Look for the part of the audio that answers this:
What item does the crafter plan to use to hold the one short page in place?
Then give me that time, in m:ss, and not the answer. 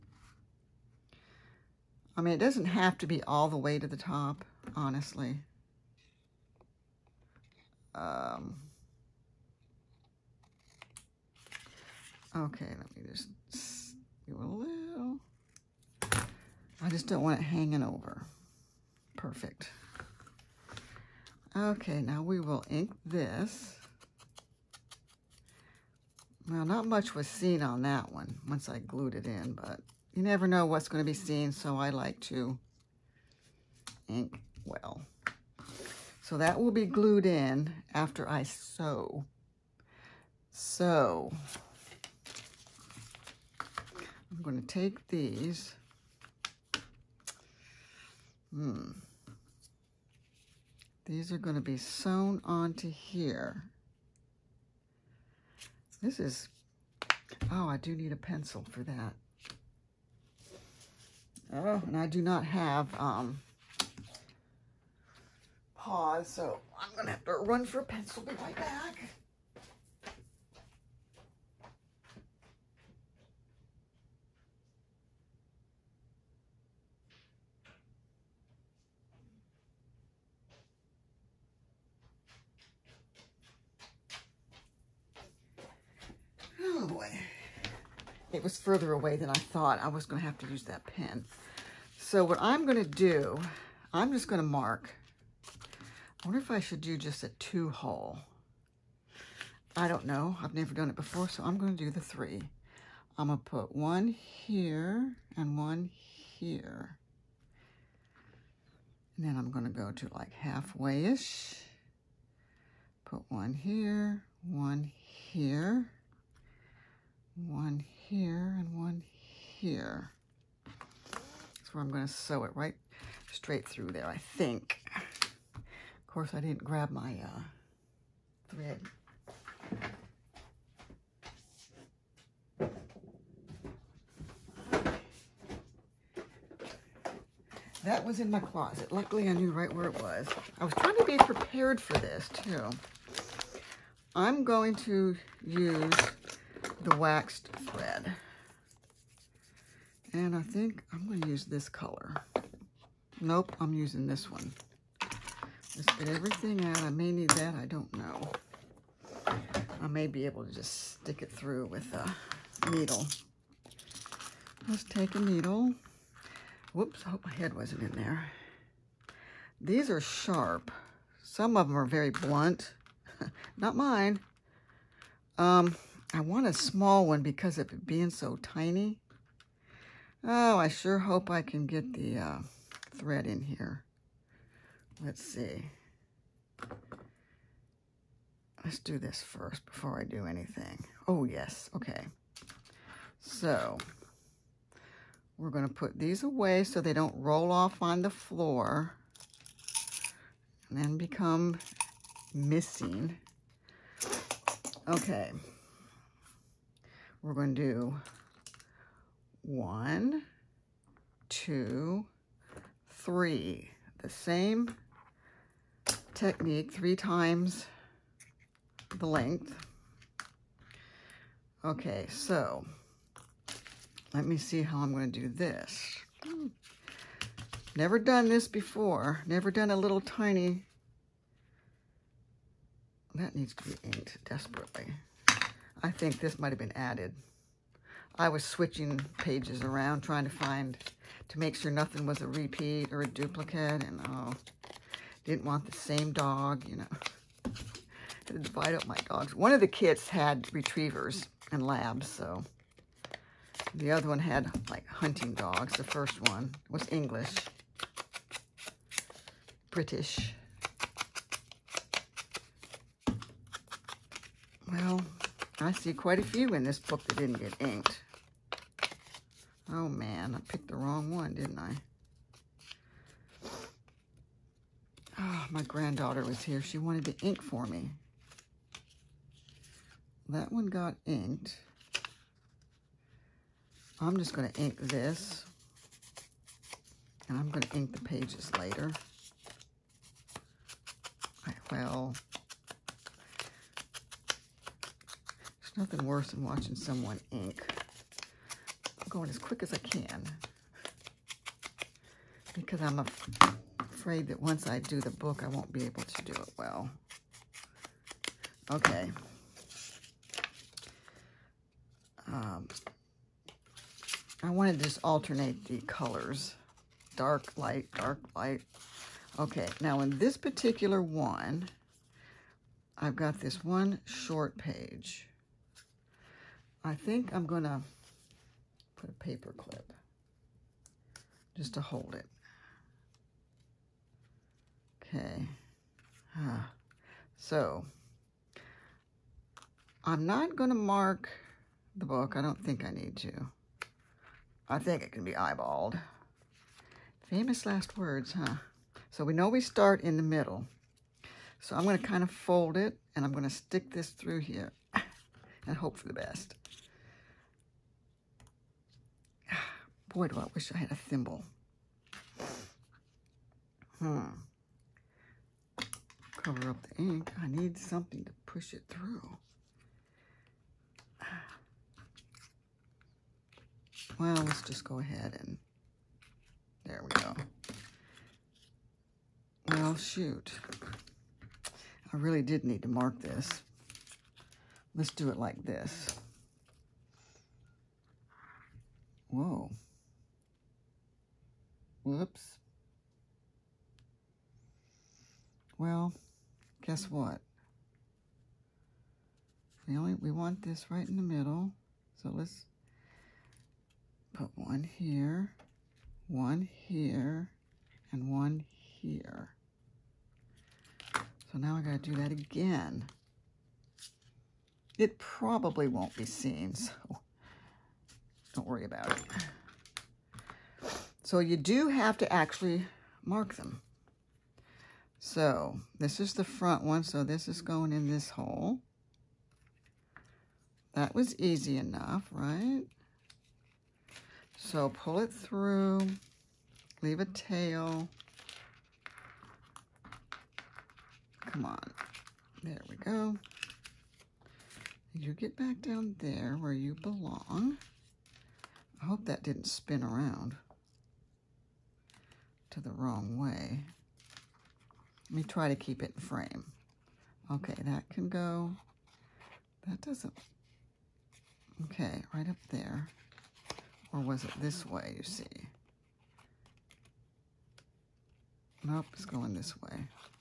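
5:29.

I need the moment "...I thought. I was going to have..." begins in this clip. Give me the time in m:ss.
1:29.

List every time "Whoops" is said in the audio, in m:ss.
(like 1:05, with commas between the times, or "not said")
2:46, 6:32.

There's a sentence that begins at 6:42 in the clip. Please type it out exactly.
So let's put one here, one here, and one here.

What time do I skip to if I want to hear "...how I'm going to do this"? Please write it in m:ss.
3:44.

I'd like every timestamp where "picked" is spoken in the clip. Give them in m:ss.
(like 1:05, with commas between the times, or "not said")
4:30.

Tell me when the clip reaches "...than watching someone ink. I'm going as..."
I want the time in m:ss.
4:56.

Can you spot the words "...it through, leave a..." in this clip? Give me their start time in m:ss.
7:15.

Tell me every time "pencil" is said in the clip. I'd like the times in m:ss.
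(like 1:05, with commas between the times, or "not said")
0:58, 1:07.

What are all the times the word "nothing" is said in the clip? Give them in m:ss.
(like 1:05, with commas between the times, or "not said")
4:01, 4:55.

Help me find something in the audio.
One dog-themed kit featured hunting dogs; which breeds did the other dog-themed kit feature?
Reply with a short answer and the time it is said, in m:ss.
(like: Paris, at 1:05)
retrievers and labs, at 4:10.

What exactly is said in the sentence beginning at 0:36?
So that will be glued in after I sew.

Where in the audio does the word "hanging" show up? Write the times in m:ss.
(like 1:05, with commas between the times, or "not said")
0:17.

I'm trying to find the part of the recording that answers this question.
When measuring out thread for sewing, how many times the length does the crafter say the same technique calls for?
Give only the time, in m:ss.
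3:36.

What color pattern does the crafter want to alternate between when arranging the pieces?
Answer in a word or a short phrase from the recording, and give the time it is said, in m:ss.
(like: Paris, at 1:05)
dark, light, at 5:17.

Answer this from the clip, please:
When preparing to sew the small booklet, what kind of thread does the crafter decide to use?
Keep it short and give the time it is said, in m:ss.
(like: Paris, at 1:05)
waxed thread, at 2:26.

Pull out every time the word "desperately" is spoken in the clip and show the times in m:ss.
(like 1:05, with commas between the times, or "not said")
3:54.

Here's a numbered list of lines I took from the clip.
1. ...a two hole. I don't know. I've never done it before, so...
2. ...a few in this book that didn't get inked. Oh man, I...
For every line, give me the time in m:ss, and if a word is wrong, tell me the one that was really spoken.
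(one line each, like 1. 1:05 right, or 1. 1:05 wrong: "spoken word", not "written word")
1. 1:37 right
2. 4:26 right.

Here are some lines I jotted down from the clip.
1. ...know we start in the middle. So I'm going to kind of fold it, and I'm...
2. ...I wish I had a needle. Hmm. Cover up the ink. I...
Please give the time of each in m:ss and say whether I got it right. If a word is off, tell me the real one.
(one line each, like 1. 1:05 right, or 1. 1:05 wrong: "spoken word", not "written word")
1. 5:49 right
2. 6:00 wrong: "thimble", not "needle".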